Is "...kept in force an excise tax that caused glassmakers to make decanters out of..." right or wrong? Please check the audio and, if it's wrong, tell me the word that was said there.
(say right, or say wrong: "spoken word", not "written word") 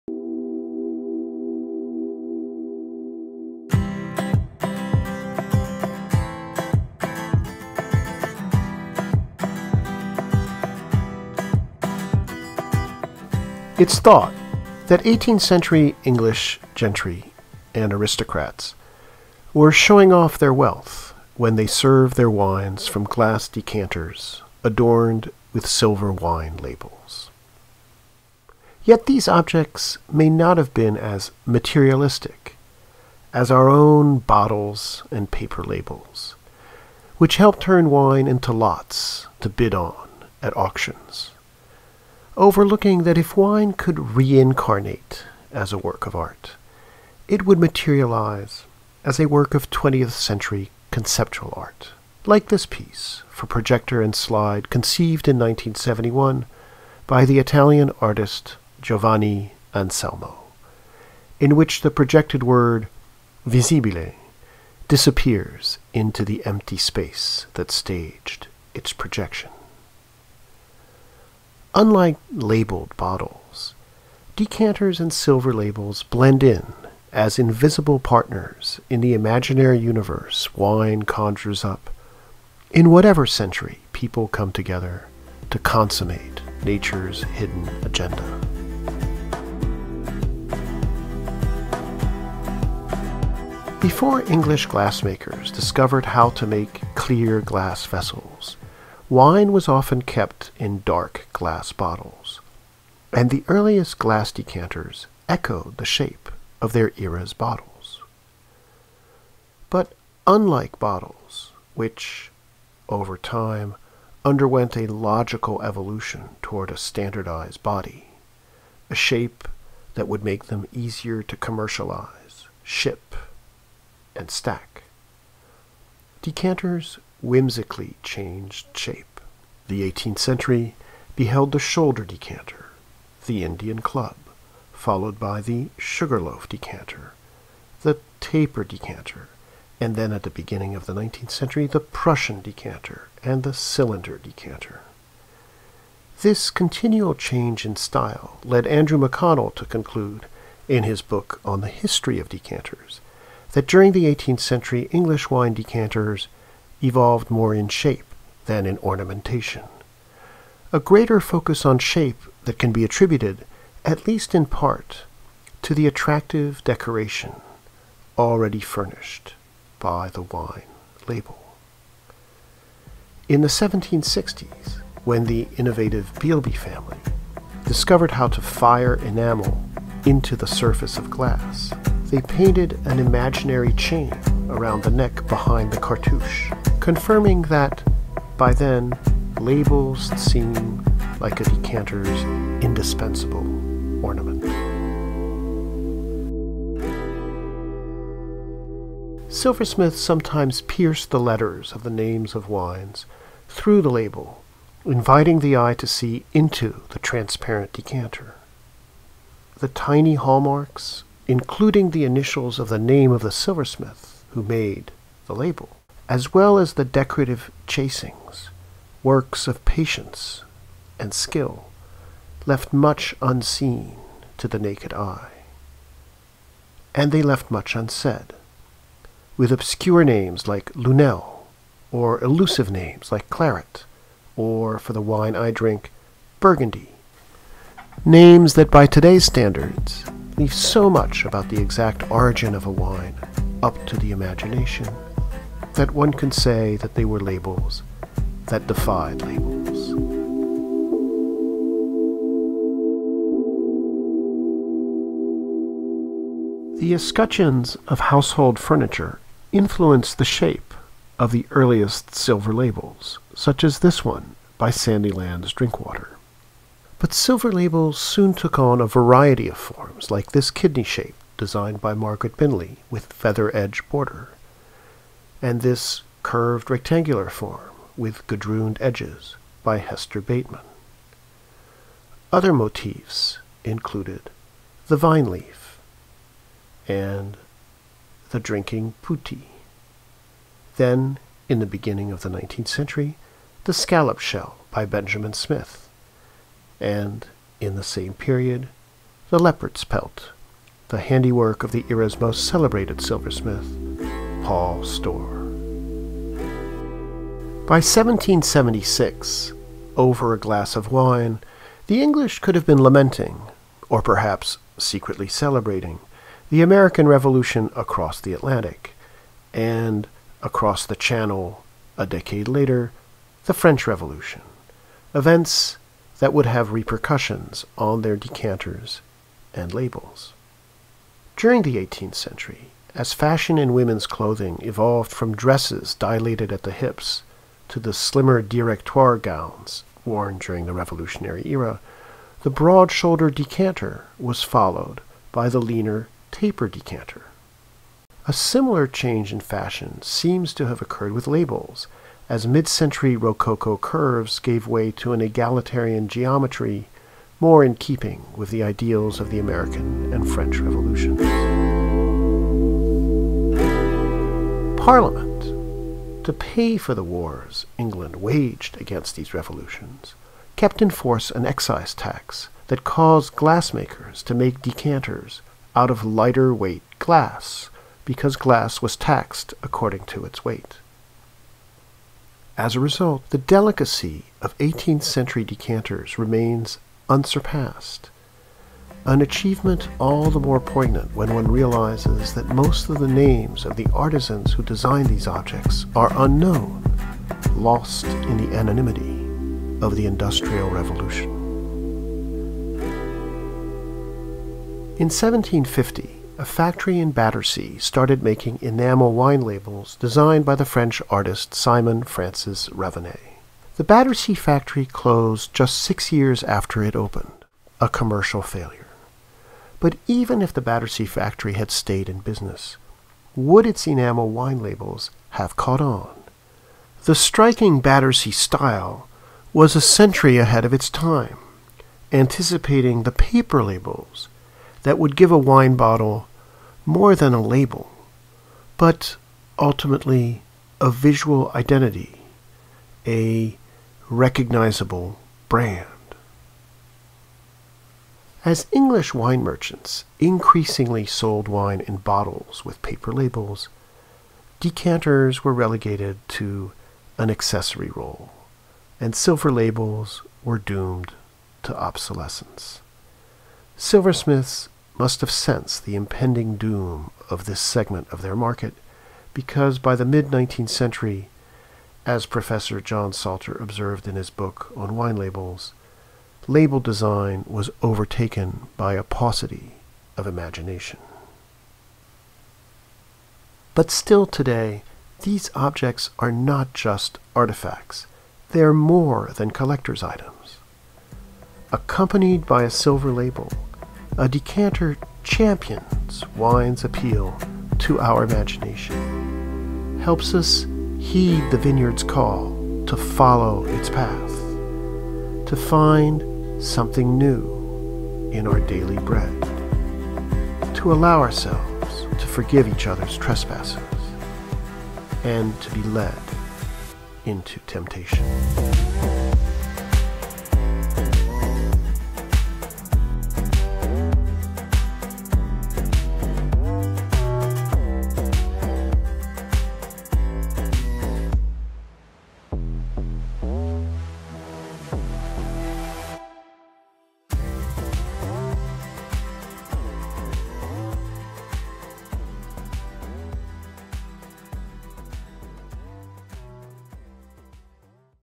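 right.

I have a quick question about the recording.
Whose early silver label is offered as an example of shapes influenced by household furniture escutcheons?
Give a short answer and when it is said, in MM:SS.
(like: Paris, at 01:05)
Sandylands Drinkwater, at 04:24.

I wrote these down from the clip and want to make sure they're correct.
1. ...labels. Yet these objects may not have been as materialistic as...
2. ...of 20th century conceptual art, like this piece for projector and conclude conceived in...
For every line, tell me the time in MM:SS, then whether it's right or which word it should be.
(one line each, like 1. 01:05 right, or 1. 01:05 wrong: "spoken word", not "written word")
1. 00:26 right
2. 00:49 wrong: "slide", not "conclude".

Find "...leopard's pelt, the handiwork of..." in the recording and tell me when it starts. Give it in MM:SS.
04:59.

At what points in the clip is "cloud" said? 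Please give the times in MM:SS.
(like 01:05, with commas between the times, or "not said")
not said.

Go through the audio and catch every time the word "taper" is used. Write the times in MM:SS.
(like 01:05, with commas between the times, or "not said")
02:18, 05:46.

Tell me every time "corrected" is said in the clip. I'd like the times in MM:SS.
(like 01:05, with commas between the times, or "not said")
not said.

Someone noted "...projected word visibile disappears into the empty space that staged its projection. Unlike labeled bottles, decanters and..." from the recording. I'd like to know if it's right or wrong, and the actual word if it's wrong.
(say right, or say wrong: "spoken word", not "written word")
right.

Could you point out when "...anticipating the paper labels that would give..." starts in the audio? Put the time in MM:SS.
07:12.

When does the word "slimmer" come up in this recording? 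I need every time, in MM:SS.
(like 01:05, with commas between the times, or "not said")
05:37.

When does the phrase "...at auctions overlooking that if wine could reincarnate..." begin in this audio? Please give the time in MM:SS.
00:40.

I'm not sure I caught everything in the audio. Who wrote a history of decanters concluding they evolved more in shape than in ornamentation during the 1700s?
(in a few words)
Andrew McConnell.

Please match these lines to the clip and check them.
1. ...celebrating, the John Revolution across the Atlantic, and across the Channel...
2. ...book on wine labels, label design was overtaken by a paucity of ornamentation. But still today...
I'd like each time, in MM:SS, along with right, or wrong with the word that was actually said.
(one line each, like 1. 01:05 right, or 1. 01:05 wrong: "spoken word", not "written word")
1. 05:15 wrong: "American", not "John"
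2. 07:54 wrong: "imagination", not "ornamentation".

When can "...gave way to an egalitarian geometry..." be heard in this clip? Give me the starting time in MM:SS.
05:54.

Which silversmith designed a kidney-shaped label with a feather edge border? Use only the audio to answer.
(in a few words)
Margaret Binley.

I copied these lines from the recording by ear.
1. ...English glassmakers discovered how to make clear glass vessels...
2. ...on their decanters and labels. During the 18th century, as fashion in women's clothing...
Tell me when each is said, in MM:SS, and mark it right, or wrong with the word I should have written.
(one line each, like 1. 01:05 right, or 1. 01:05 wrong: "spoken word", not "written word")
1. 01:34 right
2. 05:27 right.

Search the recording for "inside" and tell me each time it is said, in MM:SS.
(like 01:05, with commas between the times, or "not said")
not said.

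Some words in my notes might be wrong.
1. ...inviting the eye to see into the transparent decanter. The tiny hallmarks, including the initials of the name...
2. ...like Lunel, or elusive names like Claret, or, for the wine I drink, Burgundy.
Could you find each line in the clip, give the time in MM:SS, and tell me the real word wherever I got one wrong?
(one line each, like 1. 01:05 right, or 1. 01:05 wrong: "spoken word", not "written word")
1. 03:24 right
2. 03:50 right.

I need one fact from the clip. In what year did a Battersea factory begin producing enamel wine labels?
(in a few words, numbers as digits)
1750.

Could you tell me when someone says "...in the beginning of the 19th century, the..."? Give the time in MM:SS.
04:51.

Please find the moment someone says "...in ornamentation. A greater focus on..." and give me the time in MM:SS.
02:38.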